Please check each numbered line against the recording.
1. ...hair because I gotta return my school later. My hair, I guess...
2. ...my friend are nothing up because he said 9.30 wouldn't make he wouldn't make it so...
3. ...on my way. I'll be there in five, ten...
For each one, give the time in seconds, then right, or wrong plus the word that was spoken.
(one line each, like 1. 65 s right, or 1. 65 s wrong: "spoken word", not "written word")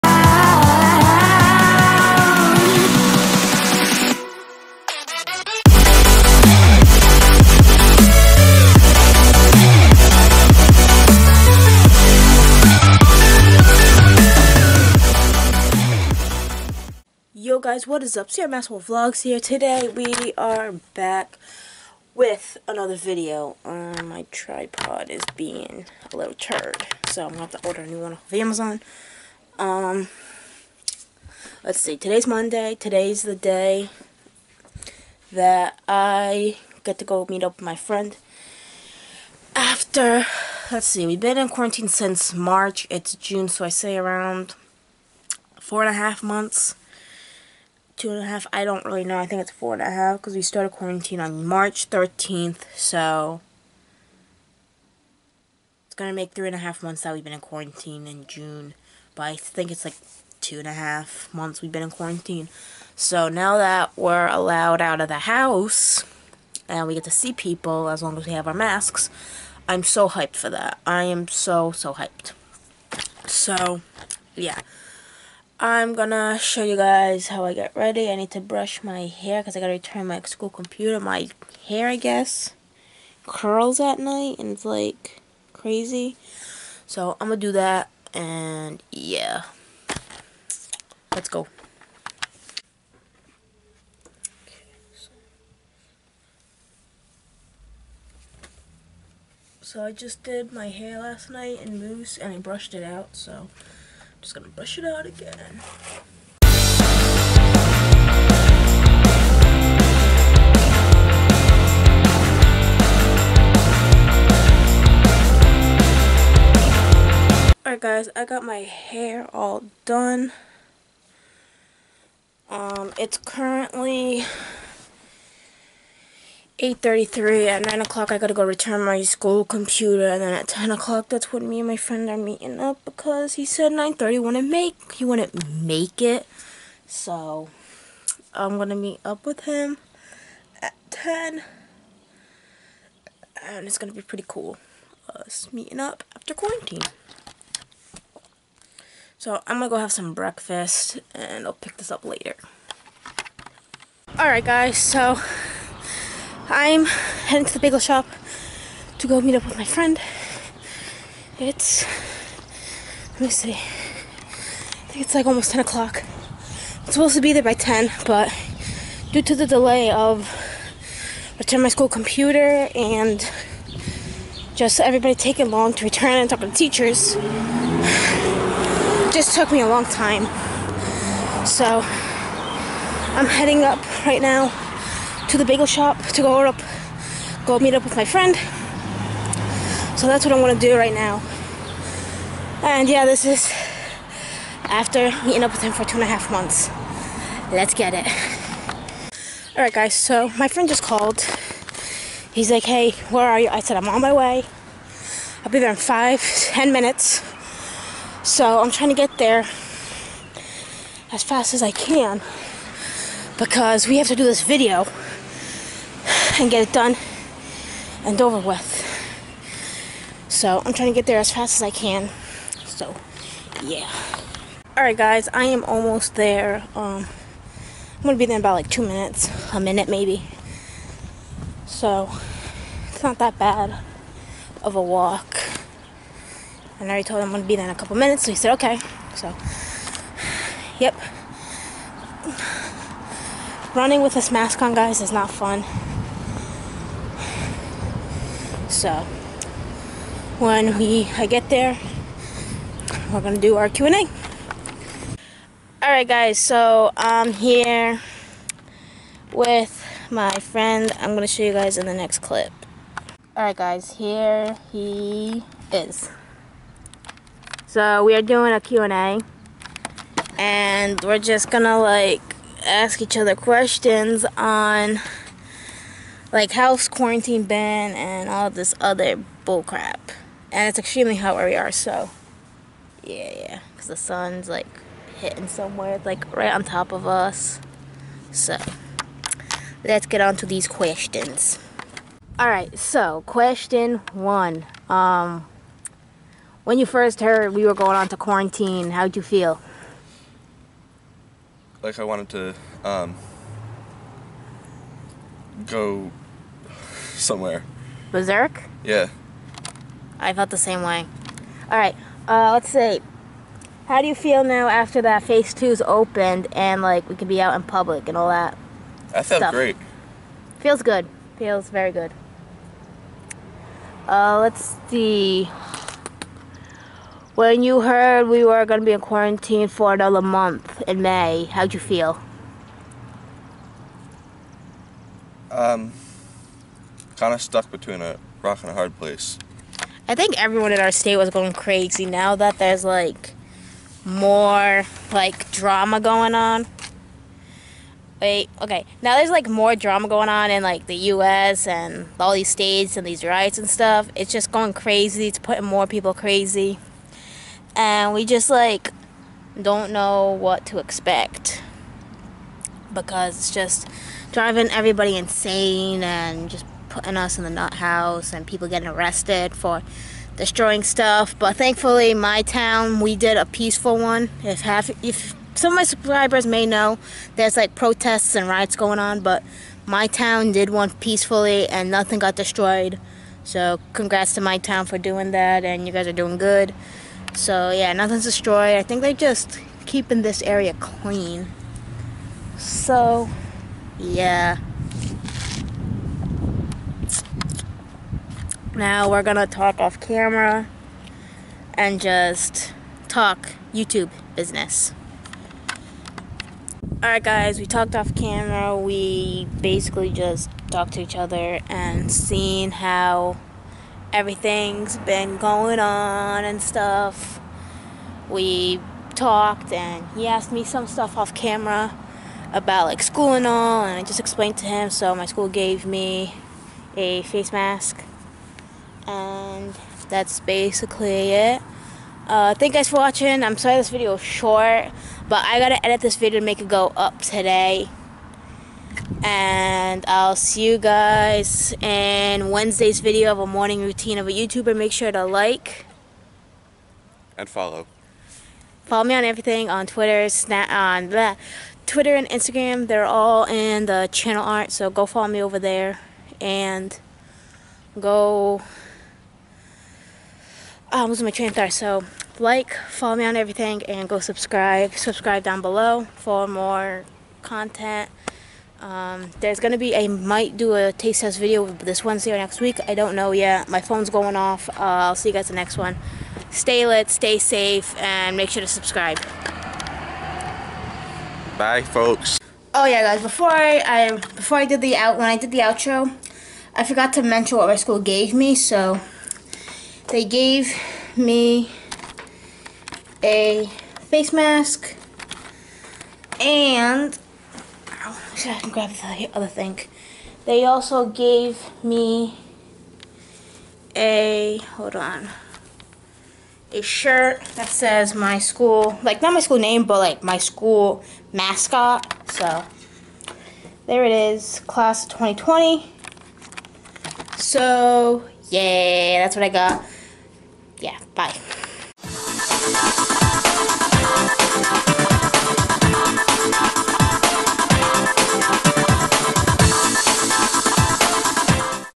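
1. 79 s wrong: "computer", not "later"
2. 131 s wrong: "meeting", not "nothing"
3. 203 s right.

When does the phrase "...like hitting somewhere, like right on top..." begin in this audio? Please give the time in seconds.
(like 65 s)
284 s.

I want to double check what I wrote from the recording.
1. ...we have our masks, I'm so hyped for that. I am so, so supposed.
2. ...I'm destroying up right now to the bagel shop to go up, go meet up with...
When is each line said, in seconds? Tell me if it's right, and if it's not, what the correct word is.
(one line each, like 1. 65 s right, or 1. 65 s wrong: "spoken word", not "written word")
1. 68 s wrong: "hyped", not "supposed"
2. 183 s wrong: "heading", not "destroying".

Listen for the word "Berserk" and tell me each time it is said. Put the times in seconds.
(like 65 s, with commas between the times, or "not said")
308 s.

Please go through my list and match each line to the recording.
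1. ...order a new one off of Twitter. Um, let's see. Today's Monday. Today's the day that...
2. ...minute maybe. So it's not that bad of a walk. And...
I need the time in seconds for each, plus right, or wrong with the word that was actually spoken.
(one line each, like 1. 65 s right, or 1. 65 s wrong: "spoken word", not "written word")
1. 27 s wrong: "Amazon", not "Twitter"
2. 229 s right.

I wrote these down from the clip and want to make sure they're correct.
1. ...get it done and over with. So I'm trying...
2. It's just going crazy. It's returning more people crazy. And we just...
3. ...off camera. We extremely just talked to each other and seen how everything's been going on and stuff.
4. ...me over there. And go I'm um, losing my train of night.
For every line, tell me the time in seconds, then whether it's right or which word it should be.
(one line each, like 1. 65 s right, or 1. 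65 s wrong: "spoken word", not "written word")
1. 216 s right
2. 354 s wrong: "putting", not "returning"
3. 407 s wrong: "basically", not "extremely"
4. 455 s wrong: "thought", not "night".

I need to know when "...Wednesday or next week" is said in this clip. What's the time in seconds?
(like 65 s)
472 s.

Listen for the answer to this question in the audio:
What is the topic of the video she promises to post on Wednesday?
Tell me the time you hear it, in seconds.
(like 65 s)
443 s.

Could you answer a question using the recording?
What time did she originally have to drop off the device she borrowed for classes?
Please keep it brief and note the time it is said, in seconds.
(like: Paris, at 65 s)
9 o'clock, at 127 s.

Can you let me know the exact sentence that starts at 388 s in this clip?
I think they're just keeping this area clean.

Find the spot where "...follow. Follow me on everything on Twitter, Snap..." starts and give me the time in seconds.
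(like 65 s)
447 s.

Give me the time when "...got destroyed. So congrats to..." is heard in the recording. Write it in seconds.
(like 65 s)
382 s.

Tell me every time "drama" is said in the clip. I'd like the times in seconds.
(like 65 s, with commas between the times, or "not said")
345 s, 349 s.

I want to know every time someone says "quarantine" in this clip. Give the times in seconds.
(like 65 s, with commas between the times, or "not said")
41 s, 50 s, 57 s, 61 s, 146 s, 276 s, 298 s, 328 s.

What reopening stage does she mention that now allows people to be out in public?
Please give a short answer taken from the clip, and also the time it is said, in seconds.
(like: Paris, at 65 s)
phase two, at 315 s.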